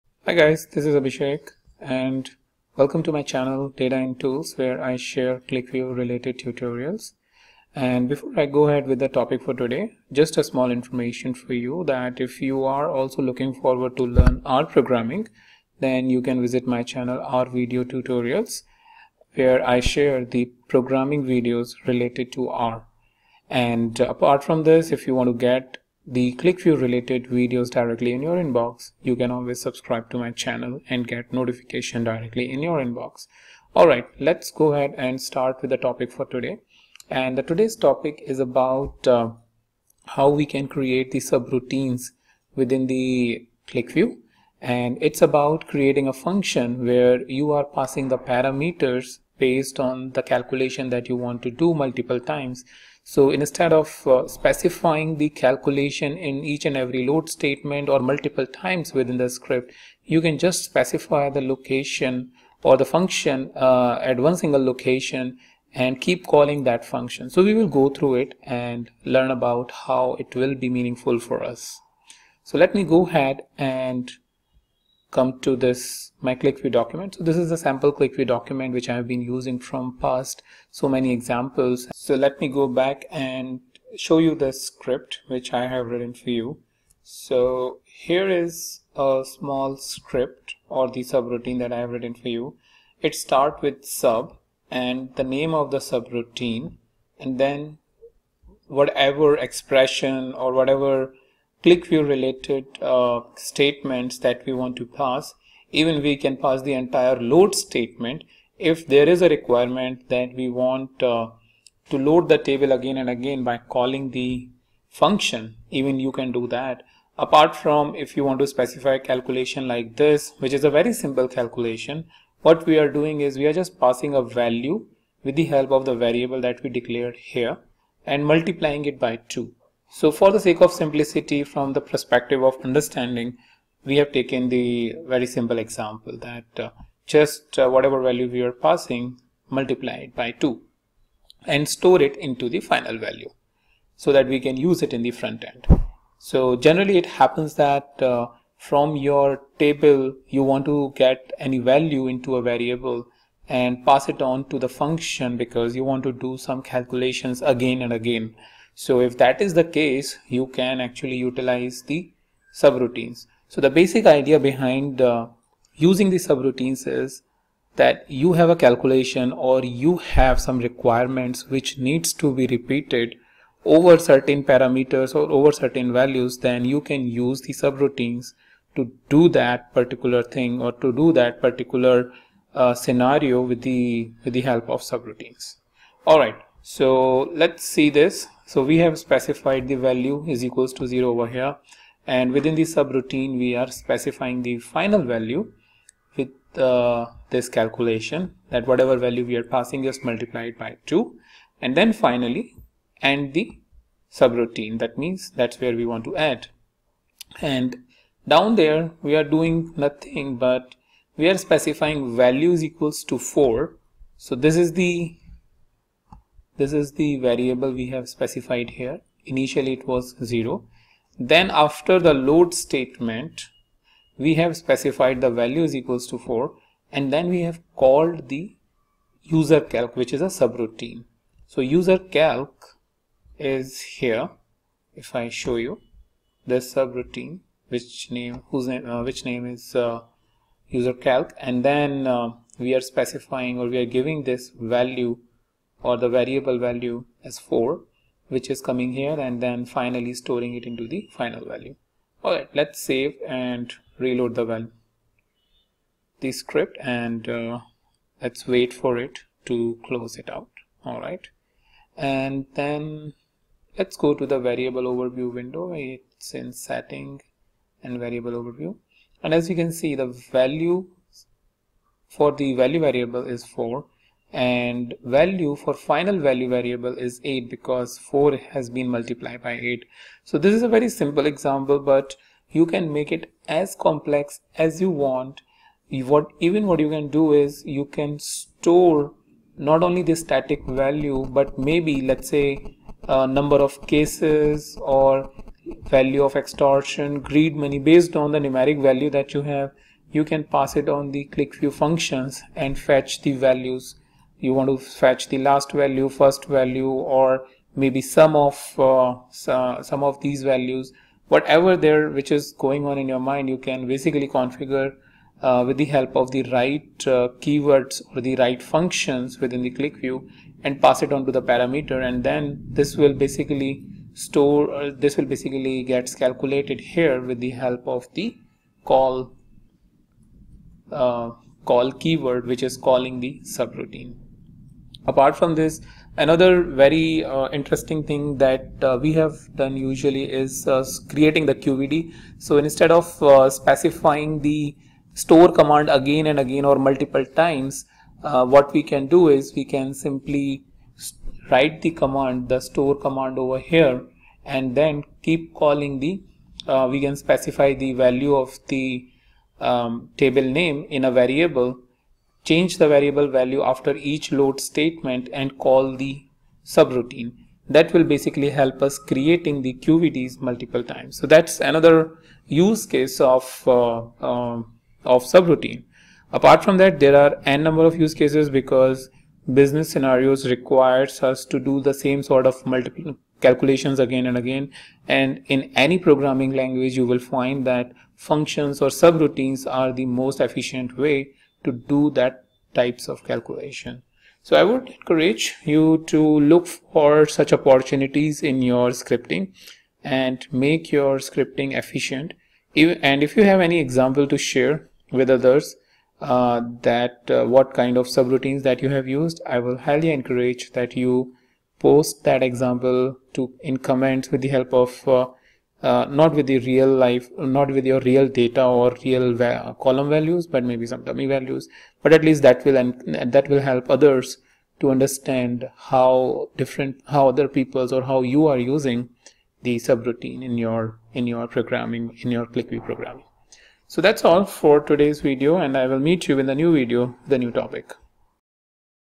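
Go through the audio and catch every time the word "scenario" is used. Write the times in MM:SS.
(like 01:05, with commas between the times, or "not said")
03:02, 06:19.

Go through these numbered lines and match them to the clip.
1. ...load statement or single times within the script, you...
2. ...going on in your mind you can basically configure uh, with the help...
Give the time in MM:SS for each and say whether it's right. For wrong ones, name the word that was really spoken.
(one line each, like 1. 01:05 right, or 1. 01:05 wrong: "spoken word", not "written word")
1. 00:57 wrong: "multiple", not "single"
2. 05:12 right.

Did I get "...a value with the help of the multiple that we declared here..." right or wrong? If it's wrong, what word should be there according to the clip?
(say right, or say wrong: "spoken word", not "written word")
wrong: "variable", not "multiple".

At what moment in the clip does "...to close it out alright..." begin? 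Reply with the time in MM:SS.
04:19.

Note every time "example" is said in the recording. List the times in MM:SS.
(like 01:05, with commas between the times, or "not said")
01:21, 02:15, 04:41, 06:43, 06:52.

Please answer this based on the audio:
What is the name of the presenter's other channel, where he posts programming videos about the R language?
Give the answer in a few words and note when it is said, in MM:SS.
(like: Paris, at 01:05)
R Video Tutorials, at 00:17.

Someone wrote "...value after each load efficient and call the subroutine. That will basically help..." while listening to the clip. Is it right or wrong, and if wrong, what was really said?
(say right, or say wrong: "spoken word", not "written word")
wrong: "statement", not "efficient".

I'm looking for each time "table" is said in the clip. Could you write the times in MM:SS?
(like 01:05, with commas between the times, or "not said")
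01:52, 02:29, 06:00.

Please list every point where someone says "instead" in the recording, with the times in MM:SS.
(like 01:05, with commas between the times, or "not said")
00:53, 05:42.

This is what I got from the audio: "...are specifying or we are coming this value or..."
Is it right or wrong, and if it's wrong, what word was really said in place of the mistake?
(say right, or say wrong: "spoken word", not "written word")
wrong: "giving", not "coming".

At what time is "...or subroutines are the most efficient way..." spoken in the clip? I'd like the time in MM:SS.
06:28.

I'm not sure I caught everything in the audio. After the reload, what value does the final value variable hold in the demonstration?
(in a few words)
8.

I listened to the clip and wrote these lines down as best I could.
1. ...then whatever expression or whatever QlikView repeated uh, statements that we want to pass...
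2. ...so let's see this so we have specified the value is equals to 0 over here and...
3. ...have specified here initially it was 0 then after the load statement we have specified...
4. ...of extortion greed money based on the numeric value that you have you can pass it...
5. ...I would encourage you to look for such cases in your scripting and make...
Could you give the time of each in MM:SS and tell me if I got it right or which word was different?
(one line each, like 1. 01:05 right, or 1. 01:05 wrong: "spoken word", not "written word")
1. 01:37 wrong: "related", not "repeated"
2. 03:06 right
3. 03:37 right
4. 04:56 right
5. 06:34 wrong: "opportunities", not "cases".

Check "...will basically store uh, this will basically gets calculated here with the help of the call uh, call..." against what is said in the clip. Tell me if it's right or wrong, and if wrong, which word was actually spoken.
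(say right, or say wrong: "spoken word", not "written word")
right.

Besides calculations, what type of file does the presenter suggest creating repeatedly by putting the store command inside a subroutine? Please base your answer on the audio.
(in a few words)
QVD.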